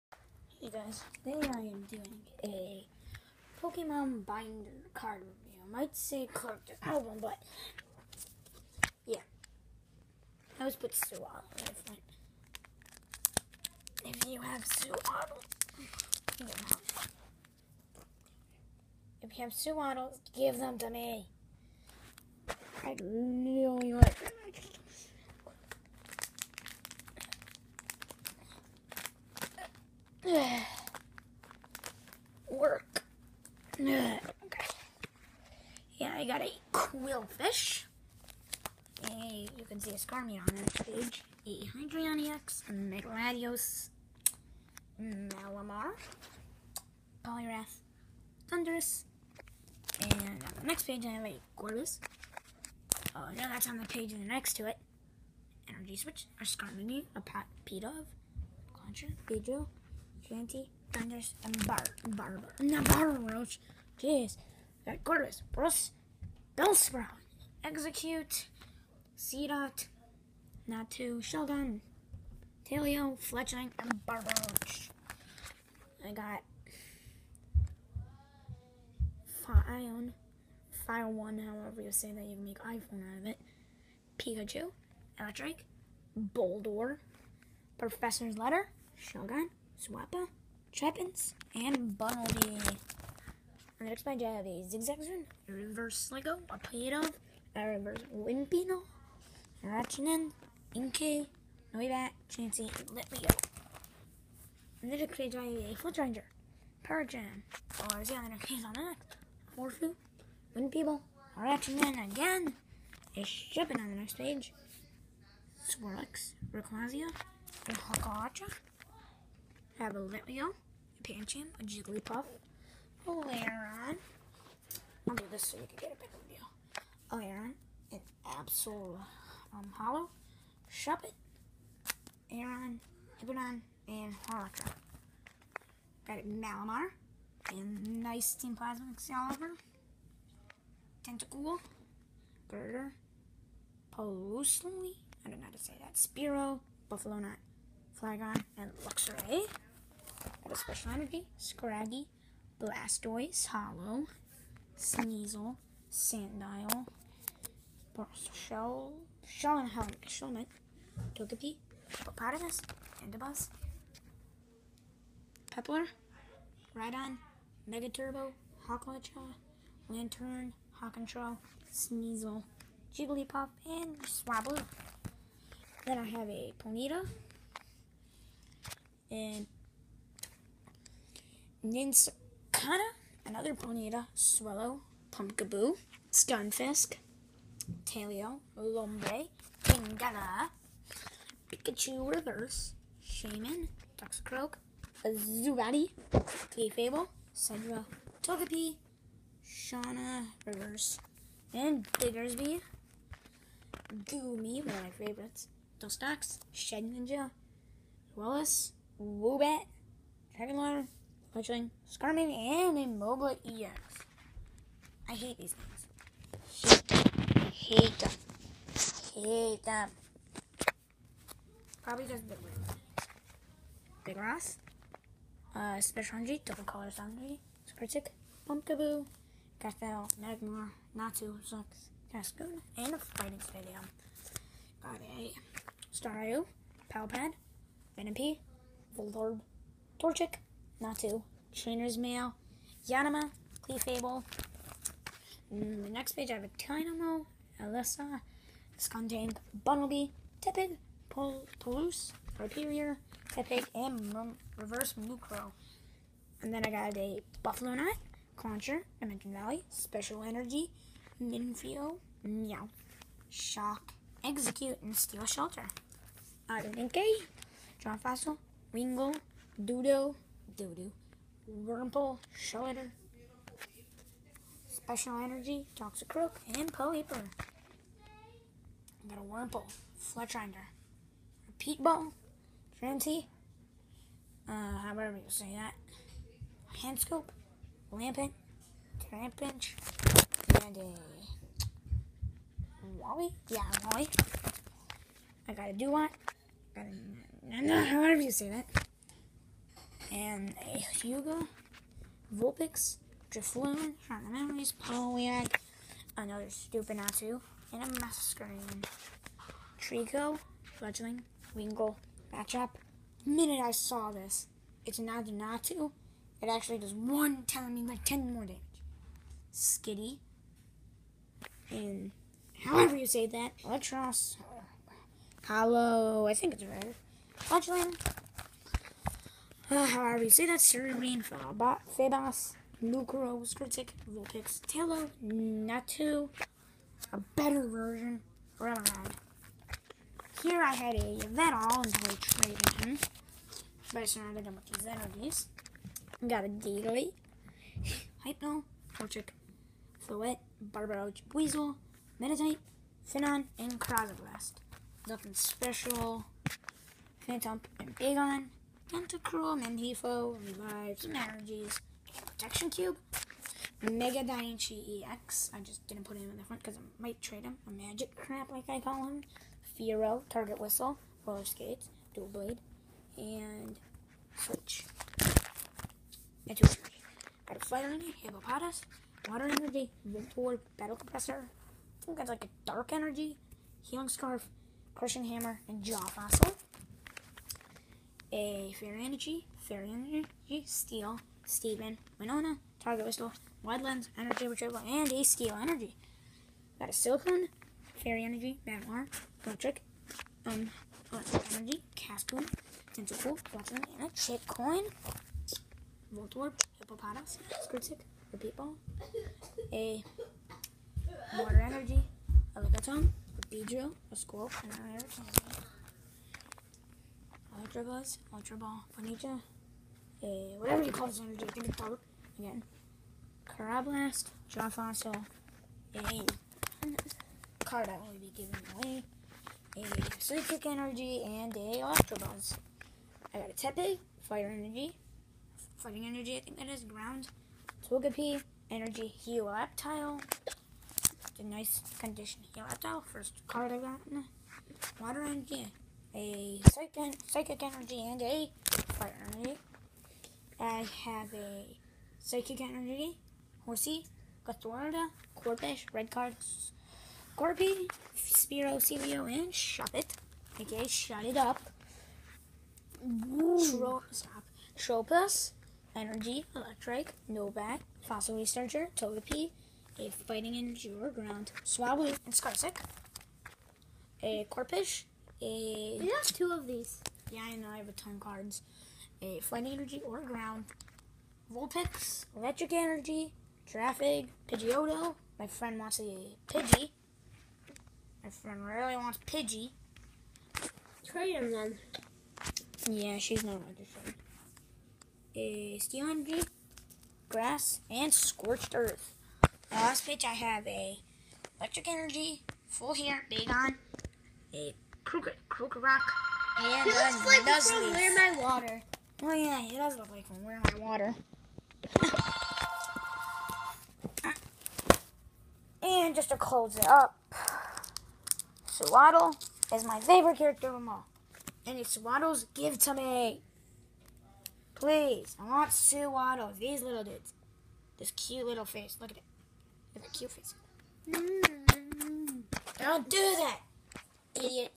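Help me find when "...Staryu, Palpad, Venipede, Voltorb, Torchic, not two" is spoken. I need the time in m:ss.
3:55.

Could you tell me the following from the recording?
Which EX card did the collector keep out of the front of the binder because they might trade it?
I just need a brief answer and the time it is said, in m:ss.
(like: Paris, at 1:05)
Mega Daiichi EX, at 6:03.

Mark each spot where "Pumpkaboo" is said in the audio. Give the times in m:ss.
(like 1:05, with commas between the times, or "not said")
3:05, 3:48.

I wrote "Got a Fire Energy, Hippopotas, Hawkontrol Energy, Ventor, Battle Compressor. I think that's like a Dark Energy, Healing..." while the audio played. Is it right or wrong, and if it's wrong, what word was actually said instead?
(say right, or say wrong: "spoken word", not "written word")
wrong: "Water", not "Hawkontrol".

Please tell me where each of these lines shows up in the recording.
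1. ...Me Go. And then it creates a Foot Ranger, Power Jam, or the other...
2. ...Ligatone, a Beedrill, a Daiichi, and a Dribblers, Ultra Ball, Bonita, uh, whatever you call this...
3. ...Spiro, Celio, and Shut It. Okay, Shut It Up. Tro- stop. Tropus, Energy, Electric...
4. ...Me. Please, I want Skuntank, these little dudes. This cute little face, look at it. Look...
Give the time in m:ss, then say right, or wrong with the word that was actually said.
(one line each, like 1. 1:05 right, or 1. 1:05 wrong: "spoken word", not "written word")
1. 1:43 right
2. 6:52 wrong: "Squirrel", not "Daiichi"
3. 7:38 right
4. 8:42 wrong: "Sewaddle", not "Skuntank".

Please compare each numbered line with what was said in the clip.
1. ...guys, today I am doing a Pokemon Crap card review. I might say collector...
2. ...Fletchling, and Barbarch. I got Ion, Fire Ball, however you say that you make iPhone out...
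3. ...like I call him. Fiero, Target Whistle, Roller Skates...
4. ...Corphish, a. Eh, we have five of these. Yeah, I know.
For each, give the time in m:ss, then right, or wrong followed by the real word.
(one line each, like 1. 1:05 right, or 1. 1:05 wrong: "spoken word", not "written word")
1. 0:00 wrong: "Binder", not "Crap"
2. 1:13 wrong: "One", not "Ball"
3. 6:08 right
4. 7:54 wrong: "two", not "five".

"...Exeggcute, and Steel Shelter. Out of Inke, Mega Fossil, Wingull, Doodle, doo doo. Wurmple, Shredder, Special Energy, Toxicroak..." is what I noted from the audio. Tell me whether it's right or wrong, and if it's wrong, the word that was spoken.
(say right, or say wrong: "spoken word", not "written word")
wrong: "John", not "Mega".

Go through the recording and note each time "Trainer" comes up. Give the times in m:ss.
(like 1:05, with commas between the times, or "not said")
4:01.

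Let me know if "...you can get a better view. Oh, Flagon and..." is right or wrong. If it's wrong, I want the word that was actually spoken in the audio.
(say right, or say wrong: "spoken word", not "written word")
wrong: "Alaron", not "Flagon".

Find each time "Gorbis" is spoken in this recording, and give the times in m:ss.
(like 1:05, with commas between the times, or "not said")
0:51, 1:05.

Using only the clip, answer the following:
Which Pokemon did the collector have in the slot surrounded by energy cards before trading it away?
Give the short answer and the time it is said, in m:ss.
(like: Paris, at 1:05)
Venom, at 5:40.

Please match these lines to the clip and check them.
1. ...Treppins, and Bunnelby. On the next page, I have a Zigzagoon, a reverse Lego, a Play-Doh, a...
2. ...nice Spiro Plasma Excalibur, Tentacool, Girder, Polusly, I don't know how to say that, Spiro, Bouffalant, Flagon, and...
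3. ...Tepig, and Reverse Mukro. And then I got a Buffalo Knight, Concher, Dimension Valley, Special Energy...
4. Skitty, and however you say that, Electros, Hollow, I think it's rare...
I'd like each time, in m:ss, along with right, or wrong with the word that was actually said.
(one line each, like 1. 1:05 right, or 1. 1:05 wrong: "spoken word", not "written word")
1. 1:30 right
2. 2:18 wrong: "Team", not "Spiro"
3. 4:13 right
4. 5:19 right.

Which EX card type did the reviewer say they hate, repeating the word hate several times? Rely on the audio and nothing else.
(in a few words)
Immobile EX.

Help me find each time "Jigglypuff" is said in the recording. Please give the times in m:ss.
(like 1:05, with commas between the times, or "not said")
2:01, 2:52.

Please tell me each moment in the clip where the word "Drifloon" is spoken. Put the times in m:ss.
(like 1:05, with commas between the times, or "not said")
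5:03.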